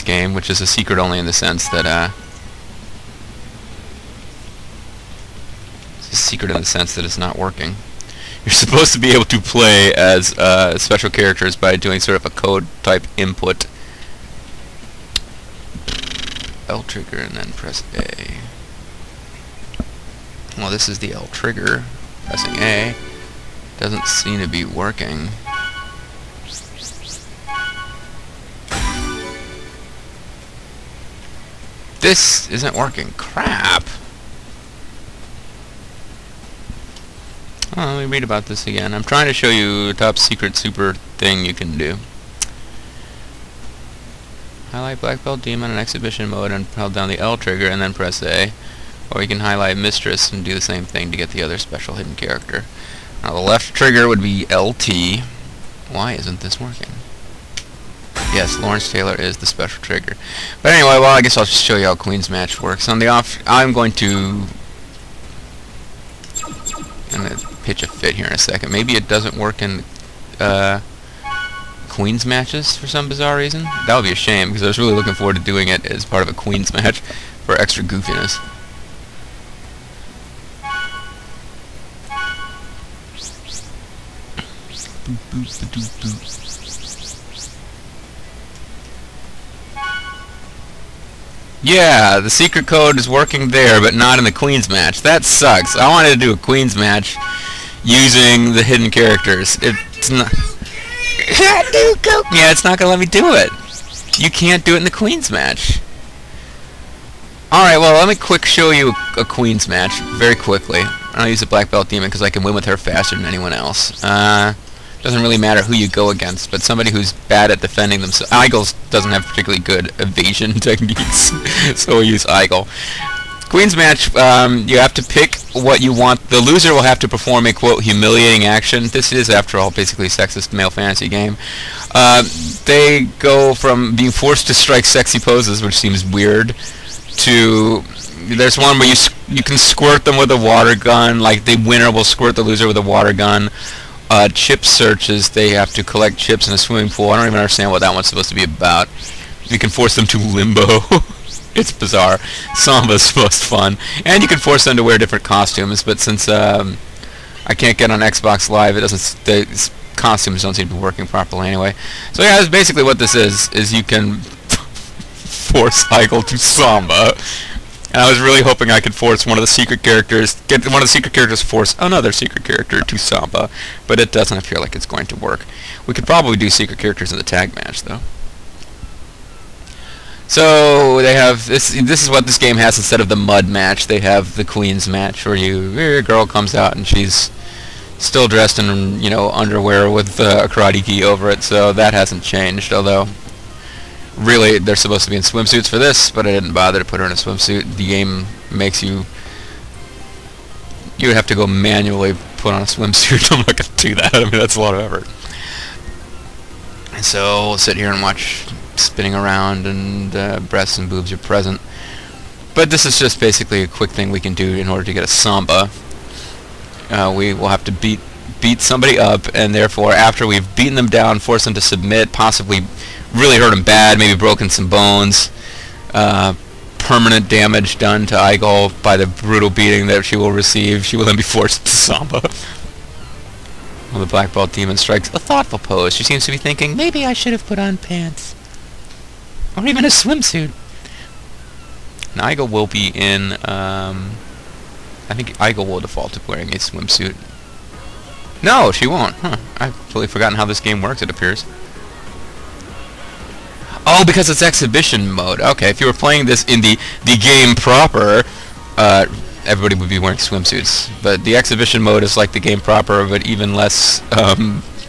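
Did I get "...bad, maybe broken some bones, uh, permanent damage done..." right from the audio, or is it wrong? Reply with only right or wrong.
right.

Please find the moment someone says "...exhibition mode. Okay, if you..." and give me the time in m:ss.
4:14.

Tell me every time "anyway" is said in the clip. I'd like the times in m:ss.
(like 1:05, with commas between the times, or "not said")
1:00, 2:41.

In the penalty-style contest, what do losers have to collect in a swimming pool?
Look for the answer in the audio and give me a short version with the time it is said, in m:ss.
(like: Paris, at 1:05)
Chips, at 2:26.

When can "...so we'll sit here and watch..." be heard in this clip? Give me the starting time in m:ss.
3:27.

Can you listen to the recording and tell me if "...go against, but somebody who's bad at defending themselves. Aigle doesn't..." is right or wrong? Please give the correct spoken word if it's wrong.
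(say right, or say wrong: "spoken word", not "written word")
right.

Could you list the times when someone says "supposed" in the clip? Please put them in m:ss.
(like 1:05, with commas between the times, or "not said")
0:08, 2:28, 3:14.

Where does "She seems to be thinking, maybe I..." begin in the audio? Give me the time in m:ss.
3:55.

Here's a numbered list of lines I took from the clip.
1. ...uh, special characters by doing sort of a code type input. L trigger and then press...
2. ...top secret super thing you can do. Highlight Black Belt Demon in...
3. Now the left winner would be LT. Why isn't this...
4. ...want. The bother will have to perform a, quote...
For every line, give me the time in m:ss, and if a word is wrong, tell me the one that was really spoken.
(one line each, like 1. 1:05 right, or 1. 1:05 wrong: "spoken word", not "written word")
1. 0:10 right
2. 0:39 right
3. 0:53 wrong: "trigger", not "winner"
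4. 2:05 wrong: "loser", not "bother".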